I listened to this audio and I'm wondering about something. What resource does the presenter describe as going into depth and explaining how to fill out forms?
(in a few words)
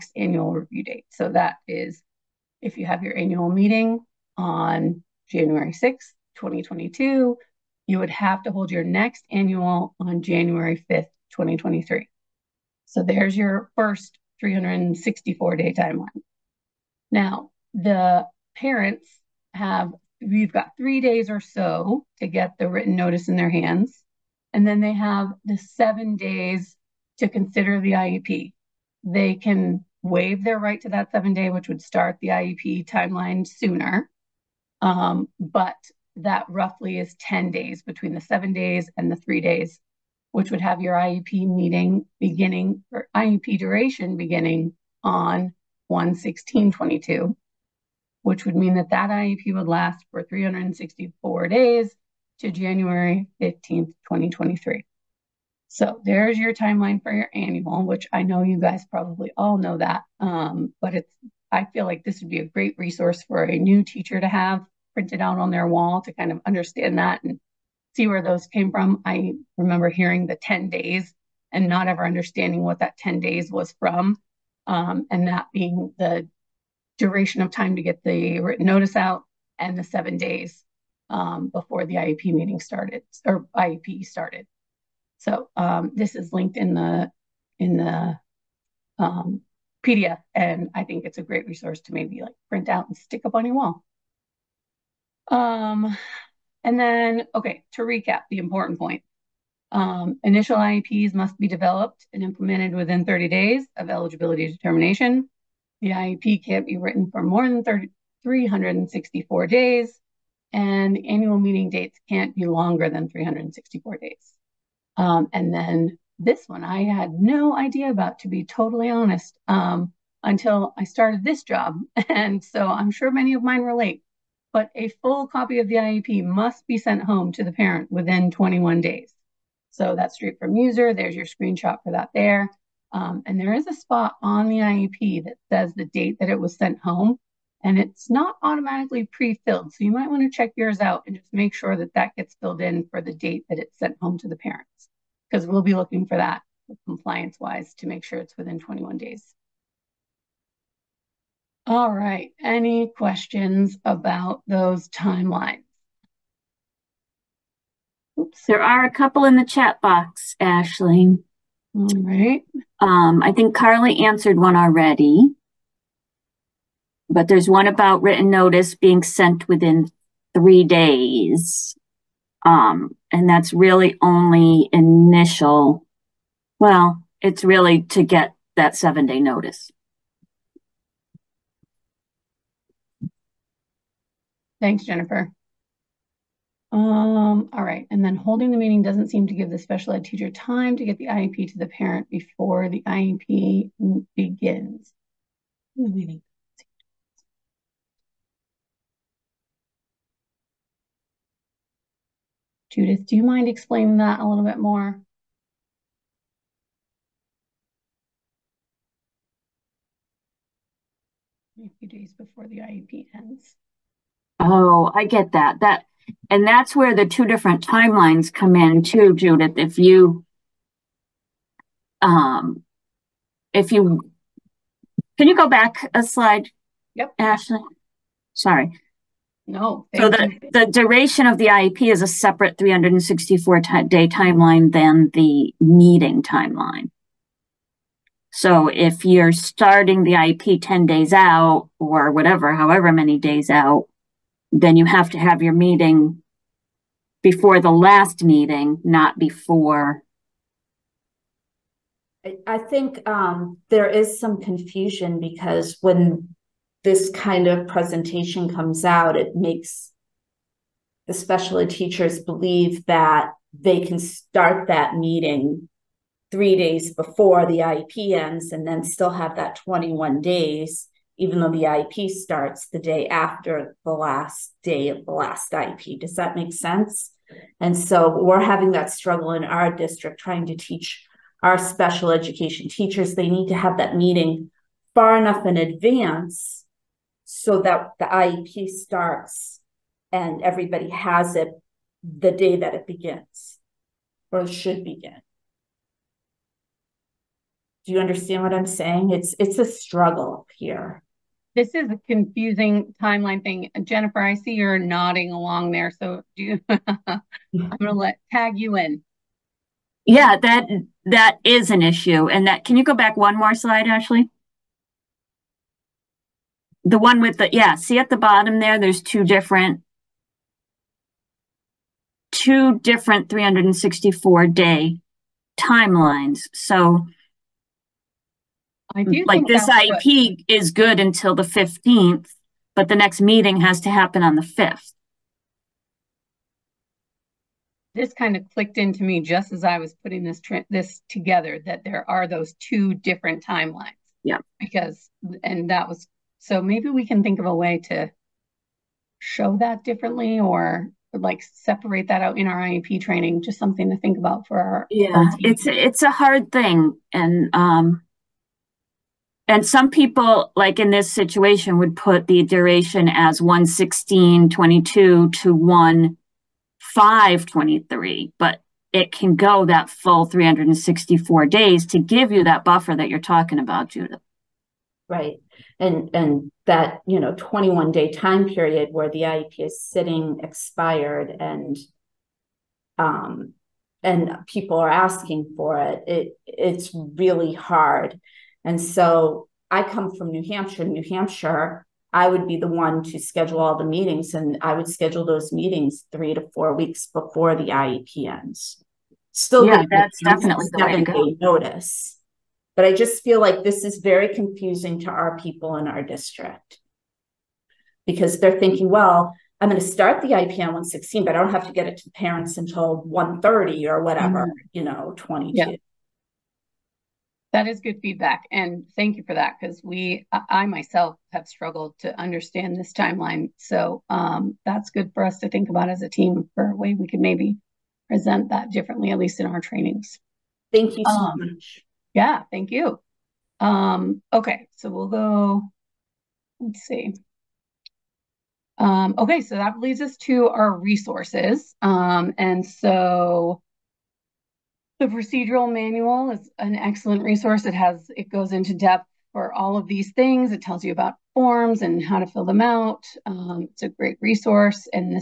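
procedural manual.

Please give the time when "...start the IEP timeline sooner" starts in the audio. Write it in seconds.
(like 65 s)
31 s.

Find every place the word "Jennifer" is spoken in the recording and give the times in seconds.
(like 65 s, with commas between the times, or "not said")
184 s, 303 s.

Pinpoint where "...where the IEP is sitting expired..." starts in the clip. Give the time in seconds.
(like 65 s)
378 s.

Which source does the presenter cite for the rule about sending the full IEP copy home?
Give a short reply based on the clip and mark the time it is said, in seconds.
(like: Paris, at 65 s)
Muser, at 130 s.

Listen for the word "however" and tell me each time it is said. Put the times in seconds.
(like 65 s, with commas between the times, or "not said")
242 s.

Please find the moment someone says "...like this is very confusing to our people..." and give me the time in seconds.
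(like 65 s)
403 s.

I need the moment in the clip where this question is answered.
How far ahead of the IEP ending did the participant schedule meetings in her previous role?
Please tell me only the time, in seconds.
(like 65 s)
396 s.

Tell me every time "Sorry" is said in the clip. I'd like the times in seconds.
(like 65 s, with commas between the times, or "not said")
228 s.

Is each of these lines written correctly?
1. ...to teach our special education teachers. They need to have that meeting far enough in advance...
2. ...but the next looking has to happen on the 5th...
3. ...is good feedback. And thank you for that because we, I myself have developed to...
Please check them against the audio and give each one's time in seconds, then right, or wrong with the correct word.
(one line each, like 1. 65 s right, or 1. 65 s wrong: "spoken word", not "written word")
1. 280 s right
2. 332 s wrong: "meeting", not "looking"
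3. 417 s wrong: "struggled", not "developed".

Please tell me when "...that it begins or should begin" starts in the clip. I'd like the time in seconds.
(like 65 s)
292 s.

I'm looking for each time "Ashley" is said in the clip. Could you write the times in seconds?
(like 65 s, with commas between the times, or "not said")
160 s, 227 s, 313 s.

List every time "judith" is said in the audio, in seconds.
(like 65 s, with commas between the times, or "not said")
202 s, 219 s, 373 s.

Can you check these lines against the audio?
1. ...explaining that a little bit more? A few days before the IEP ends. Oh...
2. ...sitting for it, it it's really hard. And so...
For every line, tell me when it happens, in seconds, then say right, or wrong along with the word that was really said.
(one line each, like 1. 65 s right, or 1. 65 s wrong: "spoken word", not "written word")
1. 203 s right
2. 384 s wrong: "asking", not "sitting".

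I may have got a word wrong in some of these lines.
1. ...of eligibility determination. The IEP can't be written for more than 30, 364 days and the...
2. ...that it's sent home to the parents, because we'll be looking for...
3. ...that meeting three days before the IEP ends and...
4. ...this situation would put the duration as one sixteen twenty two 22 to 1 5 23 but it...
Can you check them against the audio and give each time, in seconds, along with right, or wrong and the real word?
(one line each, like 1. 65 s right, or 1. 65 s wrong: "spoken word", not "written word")
1. 103 s right
2. 143 s right
3. 264 s right
4. 360 s right.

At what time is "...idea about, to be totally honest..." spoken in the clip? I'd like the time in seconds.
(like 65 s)
117 s.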